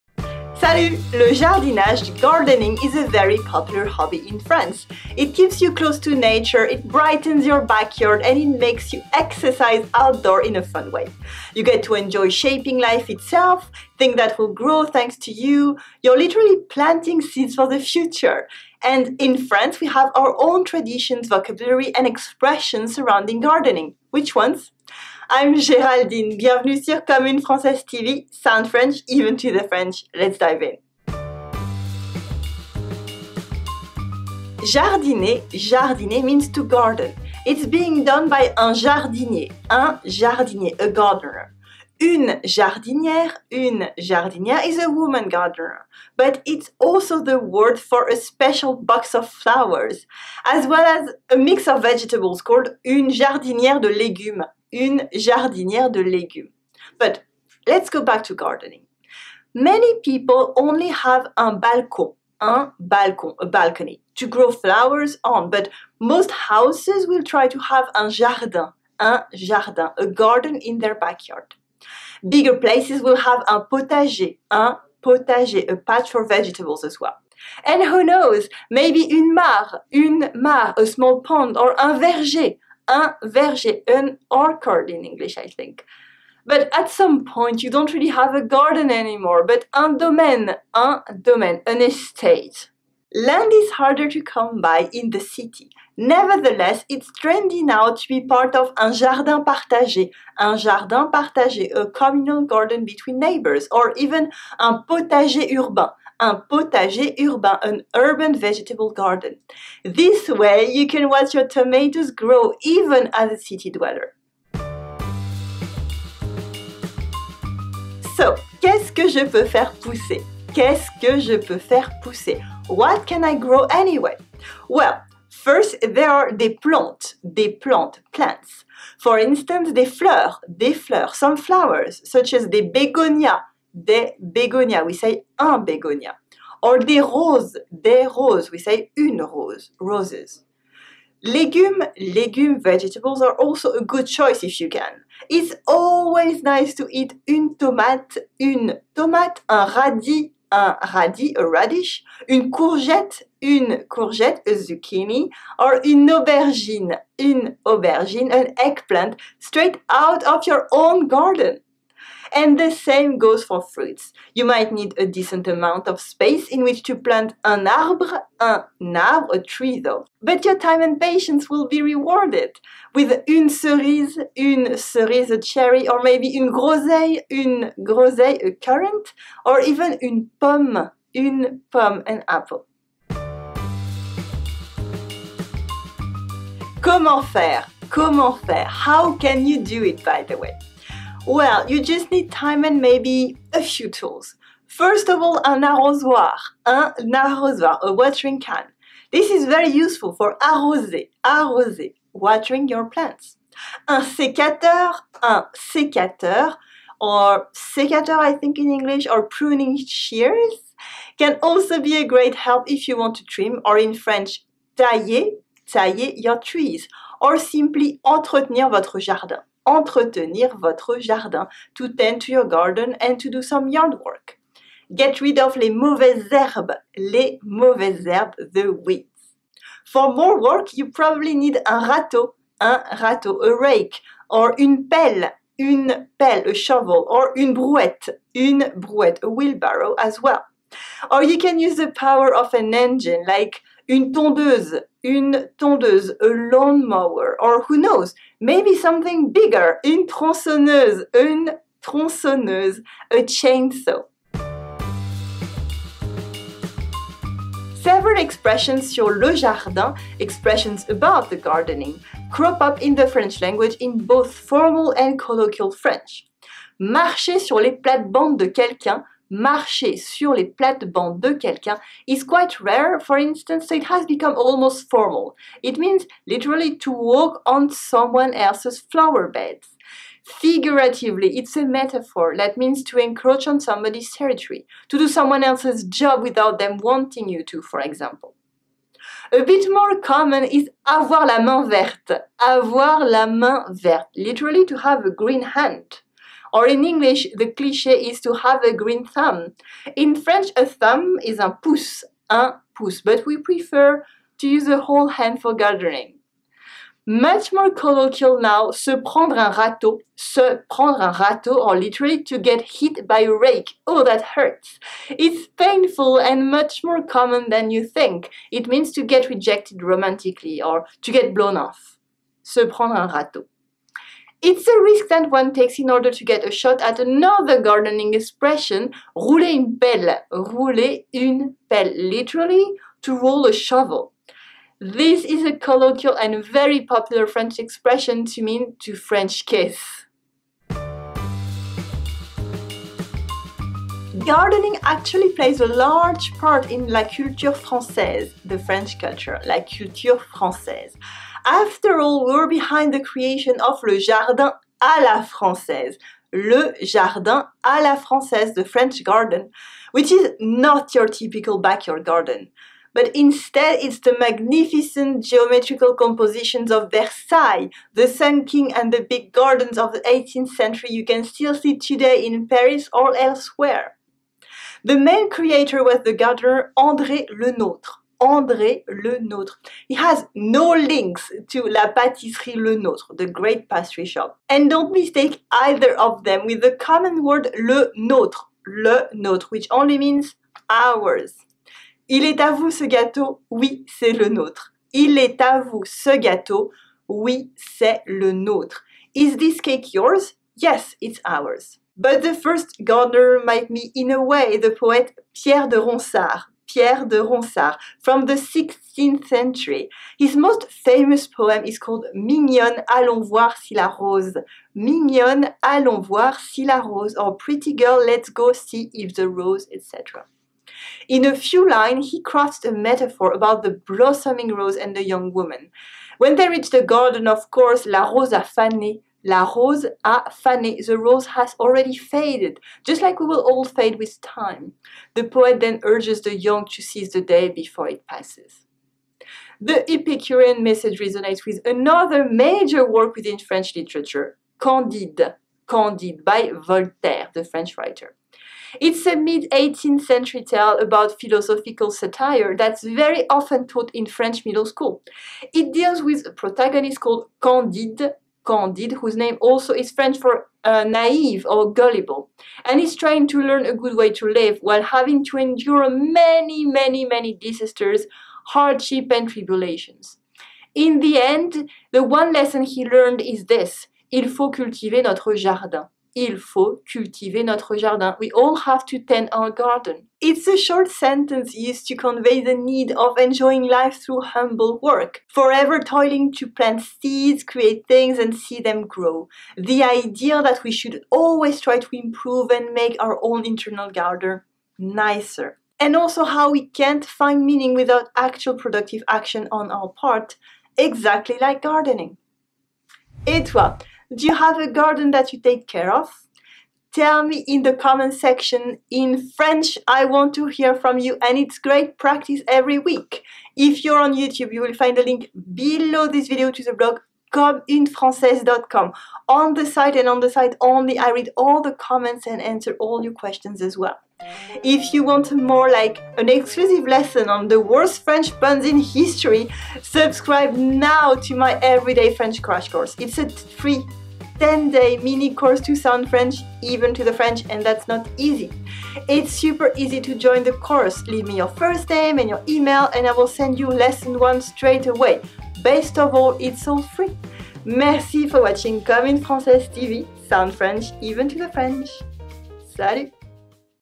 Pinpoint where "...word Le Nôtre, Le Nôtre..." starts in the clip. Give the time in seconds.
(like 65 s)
387 s.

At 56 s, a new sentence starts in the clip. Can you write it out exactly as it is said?
But let's go back to gardening.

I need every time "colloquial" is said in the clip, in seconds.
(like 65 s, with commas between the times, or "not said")
265 s, 307 s, 335 s.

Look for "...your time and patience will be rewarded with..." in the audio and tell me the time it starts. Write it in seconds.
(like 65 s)
170 s.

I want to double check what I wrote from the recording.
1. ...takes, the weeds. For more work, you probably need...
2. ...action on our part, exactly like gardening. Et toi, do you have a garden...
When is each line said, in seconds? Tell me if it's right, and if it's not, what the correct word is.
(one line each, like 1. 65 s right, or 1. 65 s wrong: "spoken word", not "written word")
1. 228 s wrong: "herbes", not "takes"
2. 499 s right.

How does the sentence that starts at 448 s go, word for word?
It's a mid 18th century tale about philosophical satire that's very often taught in French middle school.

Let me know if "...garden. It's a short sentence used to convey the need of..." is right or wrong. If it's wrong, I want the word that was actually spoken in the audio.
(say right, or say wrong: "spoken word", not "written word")
right.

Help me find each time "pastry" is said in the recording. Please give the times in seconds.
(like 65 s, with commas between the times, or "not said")
383 s.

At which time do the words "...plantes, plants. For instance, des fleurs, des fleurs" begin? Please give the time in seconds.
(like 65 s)
127 s.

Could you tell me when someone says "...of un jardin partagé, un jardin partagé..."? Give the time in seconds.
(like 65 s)
98 s.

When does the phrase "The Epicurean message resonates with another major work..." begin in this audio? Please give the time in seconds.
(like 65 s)
439 s.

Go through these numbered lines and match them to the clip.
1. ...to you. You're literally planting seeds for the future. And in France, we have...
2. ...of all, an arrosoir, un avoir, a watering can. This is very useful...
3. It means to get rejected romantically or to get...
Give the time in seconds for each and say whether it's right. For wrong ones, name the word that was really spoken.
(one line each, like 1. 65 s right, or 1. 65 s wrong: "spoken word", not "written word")
1. 15 s right
2. 195 s wrong: "arrosoir", not "avoir"
3. 318 s right.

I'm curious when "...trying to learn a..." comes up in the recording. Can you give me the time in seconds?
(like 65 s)
462 s.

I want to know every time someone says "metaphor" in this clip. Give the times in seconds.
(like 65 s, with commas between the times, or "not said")
281 s, 422 s.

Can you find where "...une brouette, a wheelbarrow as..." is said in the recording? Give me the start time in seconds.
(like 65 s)
238 s.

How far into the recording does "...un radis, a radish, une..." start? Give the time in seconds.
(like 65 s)
150 s.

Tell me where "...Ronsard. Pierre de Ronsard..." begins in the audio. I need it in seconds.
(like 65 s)
405 s.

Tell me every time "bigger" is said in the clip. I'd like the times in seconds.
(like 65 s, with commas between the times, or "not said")
72 s, 249 s.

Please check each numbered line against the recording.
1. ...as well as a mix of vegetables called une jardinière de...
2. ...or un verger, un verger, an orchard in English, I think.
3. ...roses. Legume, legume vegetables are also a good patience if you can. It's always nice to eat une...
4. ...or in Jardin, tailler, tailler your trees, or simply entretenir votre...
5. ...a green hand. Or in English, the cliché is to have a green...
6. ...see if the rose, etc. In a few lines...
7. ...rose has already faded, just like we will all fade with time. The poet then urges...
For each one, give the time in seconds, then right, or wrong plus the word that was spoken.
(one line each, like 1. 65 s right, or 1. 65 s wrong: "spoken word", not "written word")
1. 50 s right
2. 81 s right
3. 139 s wrong: "choice", not "patience"
4. 213 s wrong: "French", not "Jardin"
5. 295 s right
6. 418 s right
7. 430 s right.